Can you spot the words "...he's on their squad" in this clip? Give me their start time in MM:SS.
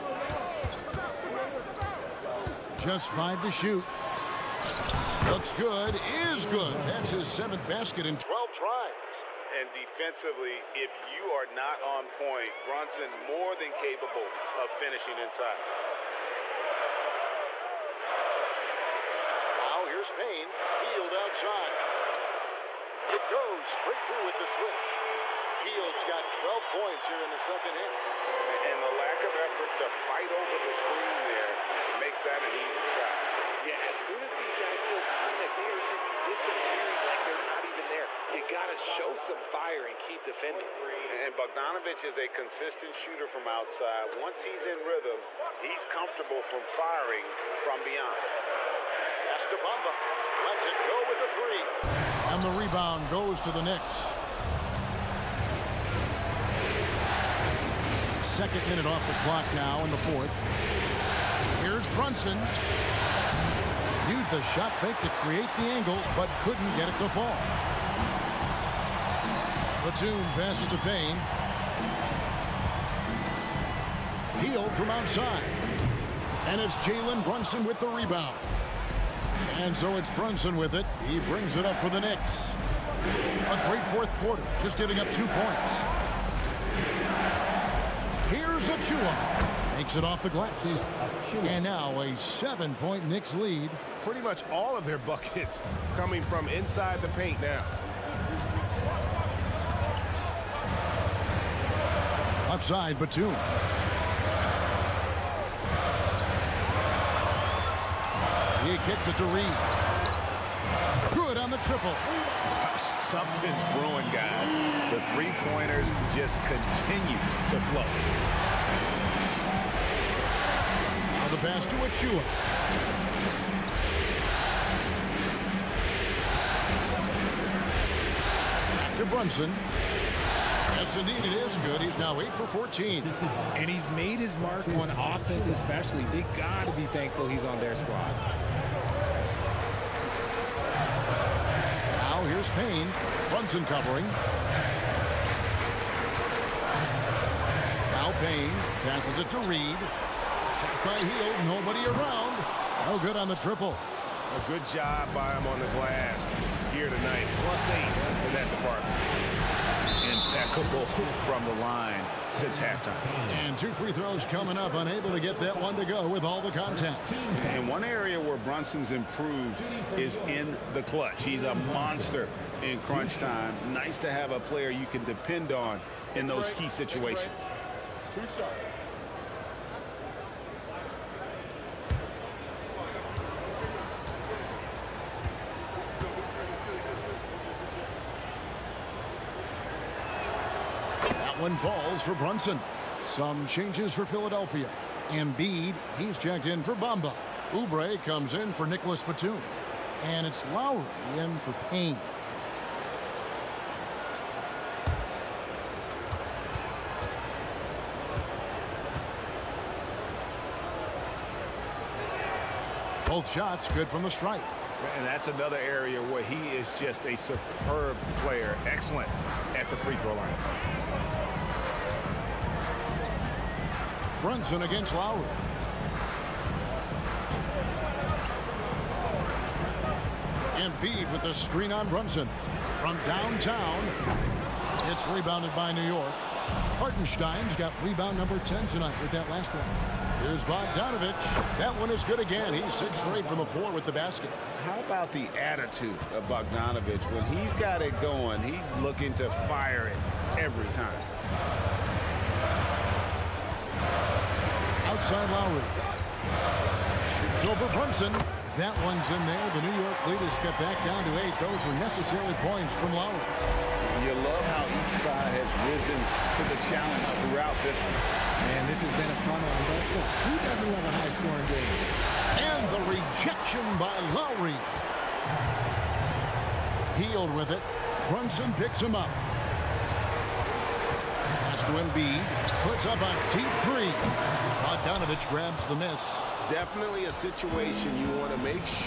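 02:17.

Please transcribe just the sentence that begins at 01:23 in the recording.
A great fourth quarter, just giving up two points.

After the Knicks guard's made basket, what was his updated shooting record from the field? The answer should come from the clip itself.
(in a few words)
8 for 14.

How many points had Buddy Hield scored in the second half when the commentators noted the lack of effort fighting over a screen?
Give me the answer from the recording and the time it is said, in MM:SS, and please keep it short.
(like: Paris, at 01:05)
12, at 00:26.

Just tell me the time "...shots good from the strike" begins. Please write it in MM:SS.
03:33.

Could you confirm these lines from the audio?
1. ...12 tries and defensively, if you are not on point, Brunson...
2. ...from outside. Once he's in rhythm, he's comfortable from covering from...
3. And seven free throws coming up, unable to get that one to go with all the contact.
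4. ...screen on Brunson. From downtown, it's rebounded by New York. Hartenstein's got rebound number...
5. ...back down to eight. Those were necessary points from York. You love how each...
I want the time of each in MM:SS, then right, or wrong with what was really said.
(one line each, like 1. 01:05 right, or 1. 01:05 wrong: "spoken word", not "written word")
1. 00:08 right
2. 00:43 wrong: "firing", not "covering"
3. 02:43 wrong: "two", not "seven"
4. 03:51 right
5. 04:20 wrong: "Lowry", not "York".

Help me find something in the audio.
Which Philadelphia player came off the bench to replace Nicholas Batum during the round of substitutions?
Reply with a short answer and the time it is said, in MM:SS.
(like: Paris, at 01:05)
Oubre, at 03:17.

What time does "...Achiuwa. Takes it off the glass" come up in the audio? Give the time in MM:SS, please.
01:28.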